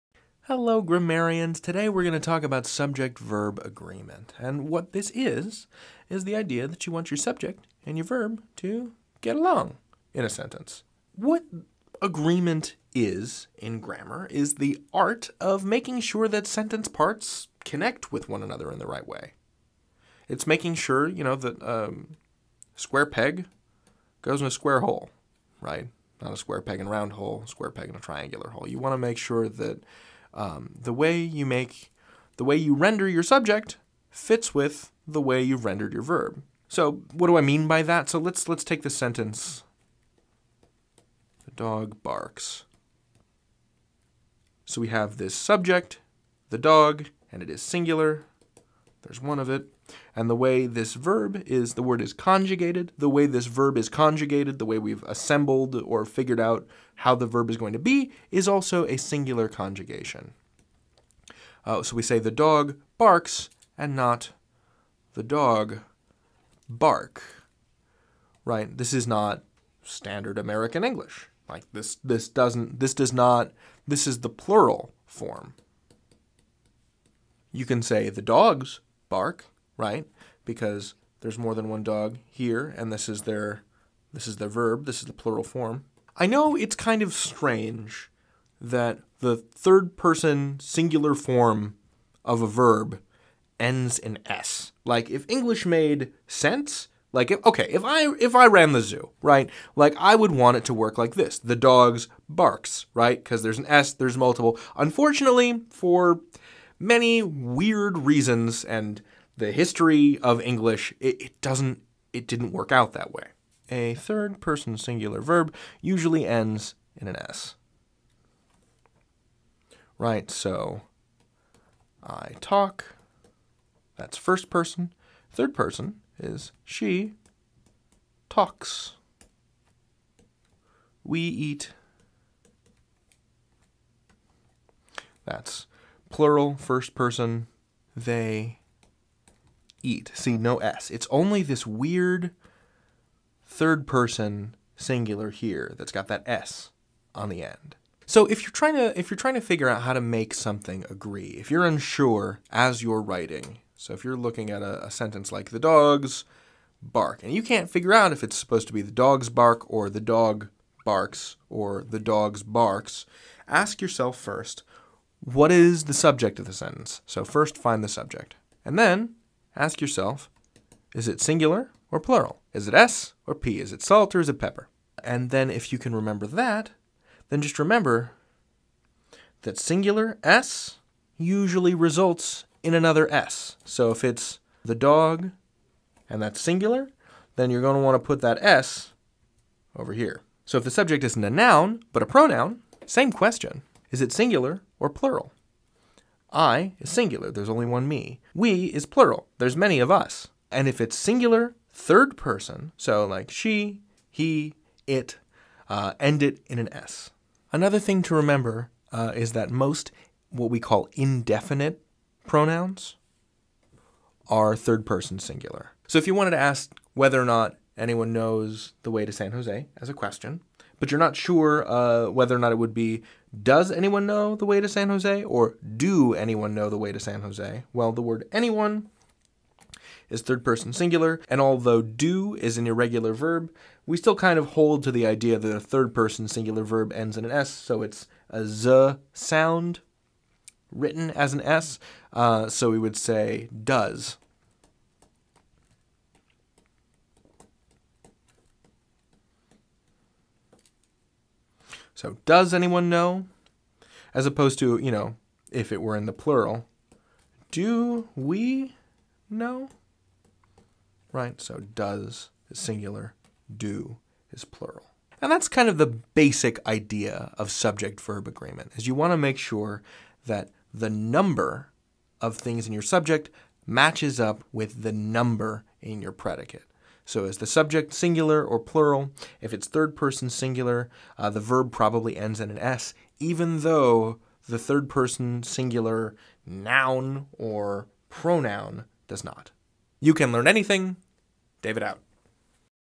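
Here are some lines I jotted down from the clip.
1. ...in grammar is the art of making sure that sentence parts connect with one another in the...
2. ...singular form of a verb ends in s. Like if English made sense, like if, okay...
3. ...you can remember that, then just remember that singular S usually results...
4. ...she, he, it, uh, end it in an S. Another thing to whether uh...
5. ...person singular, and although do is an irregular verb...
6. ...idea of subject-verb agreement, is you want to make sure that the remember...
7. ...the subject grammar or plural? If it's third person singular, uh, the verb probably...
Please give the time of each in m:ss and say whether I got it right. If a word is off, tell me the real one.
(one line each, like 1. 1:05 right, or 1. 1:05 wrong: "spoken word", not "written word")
1. 0:13 right
2. 1:30 right
3. 2:55 right
4. 3:23 wrong: "remember", not "whether"
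5. 3:50 right
6. 4:26 wrong: "number", not "remember"
7. 4:37 wrong: "singular", not "grammar".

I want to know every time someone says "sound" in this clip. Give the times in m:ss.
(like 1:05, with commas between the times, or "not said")
3:59.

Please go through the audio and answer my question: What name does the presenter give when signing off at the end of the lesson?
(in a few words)
David.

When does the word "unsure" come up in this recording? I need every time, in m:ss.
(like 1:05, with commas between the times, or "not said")
2:31.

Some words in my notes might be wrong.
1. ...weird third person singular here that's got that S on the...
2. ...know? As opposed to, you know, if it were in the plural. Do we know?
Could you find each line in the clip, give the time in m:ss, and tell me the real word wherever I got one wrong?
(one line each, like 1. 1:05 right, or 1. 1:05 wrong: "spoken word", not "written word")
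1. 2:21 right
2. 4:12 right.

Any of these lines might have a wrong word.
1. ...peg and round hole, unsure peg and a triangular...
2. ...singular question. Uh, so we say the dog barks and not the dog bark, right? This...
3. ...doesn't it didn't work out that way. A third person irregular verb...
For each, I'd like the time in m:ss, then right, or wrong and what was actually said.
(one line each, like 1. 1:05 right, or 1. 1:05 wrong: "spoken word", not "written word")
1. 0:26 wrong: "square", not "unsure"
2. 0:58 wrong: "conjugation", not "question"
3. 1:51 wrong: "singular", not "irregular".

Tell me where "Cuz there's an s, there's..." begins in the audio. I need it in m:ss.
1:43.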